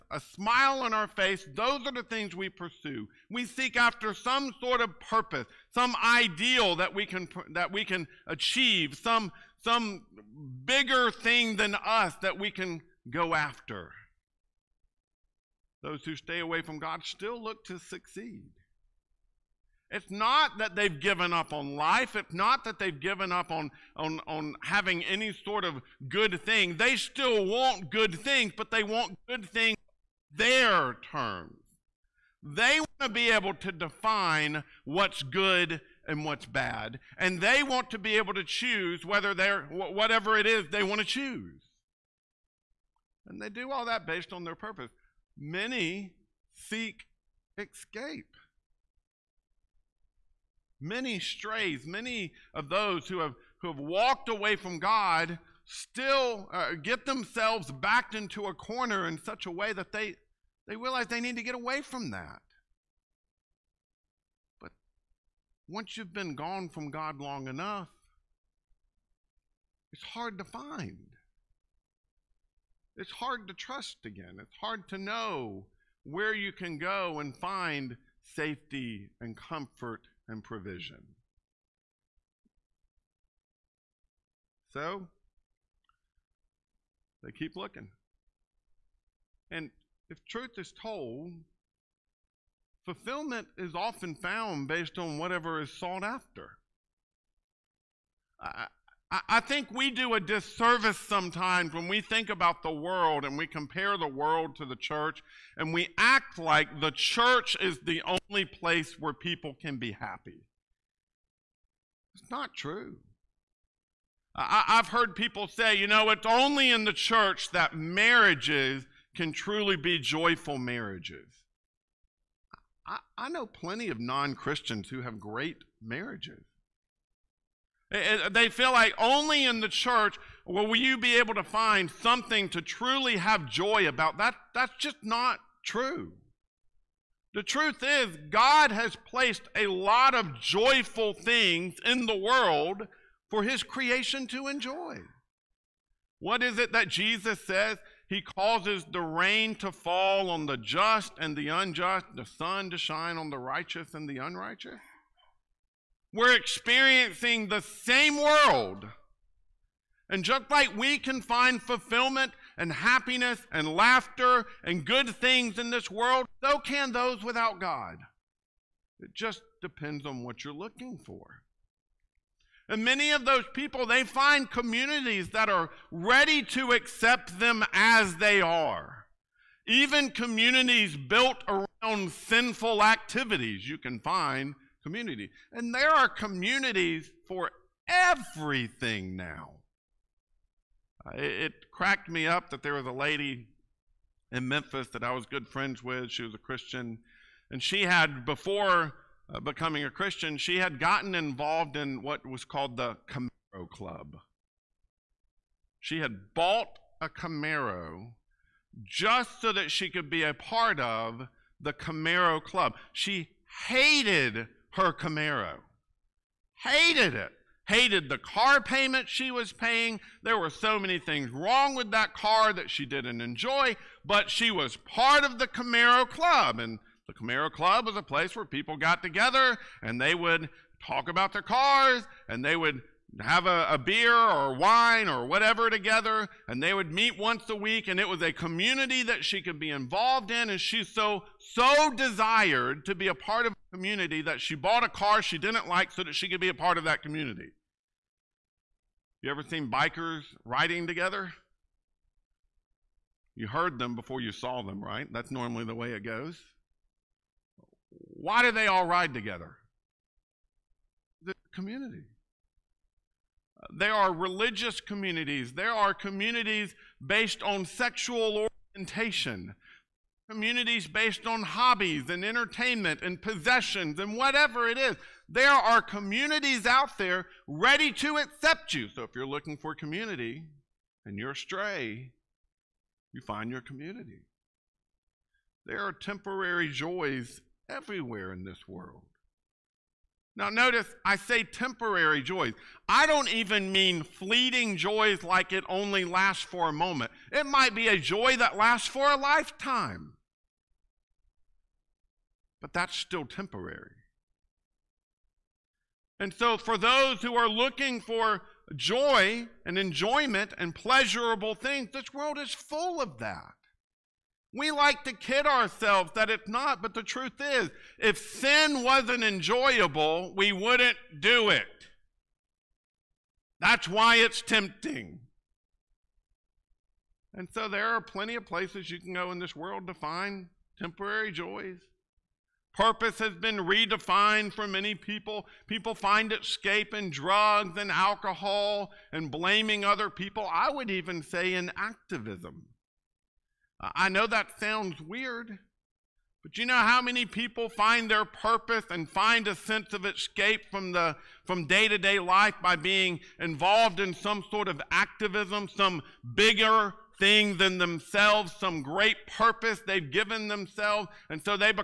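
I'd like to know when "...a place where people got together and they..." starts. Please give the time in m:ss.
3:47.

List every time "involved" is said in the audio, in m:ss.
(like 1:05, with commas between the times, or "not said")
3:21, 3:59, 5:53.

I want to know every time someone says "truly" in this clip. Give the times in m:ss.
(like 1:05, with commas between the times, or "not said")
1:59, 2:12.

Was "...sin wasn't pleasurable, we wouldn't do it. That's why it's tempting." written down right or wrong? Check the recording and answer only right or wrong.
wrong.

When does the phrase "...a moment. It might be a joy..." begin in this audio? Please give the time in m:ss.
4:56.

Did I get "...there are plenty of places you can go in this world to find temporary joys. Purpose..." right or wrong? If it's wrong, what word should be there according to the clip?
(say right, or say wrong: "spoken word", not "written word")
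right.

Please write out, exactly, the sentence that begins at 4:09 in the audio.
You ever seen bikers riding together?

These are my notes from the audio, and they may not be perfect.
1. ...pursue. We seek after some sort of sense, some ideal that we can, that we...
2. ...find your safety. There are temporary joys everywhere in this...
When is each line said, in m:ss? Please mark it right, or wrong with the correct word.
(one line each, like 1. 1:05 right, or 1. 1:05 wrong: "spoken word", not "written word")
1. 0:02 wrong: "purpose", not "sense"
2. 4:43 wrong: "community", not "safety".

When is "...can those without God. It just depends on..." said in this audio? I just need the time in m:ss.
2:46.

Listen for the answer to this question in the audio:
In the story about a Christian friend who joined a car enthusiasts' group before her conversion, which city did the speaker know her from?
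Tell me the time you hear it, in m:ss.
3:14.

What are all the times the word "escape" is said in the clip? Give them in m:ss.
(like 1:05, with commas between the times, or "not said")
0:47, 5:36, 5:50.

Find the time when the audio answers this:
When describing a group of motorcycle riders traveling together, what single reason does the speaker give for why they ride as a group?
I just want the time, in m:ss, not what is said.
4:21.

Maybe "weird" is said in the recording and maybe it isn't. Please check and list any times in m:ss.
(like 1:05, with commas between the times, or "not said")
5:44.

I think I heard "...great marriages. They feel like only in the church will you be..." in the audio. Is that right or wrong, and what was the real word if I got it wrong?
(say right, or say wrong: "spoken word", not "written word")
right.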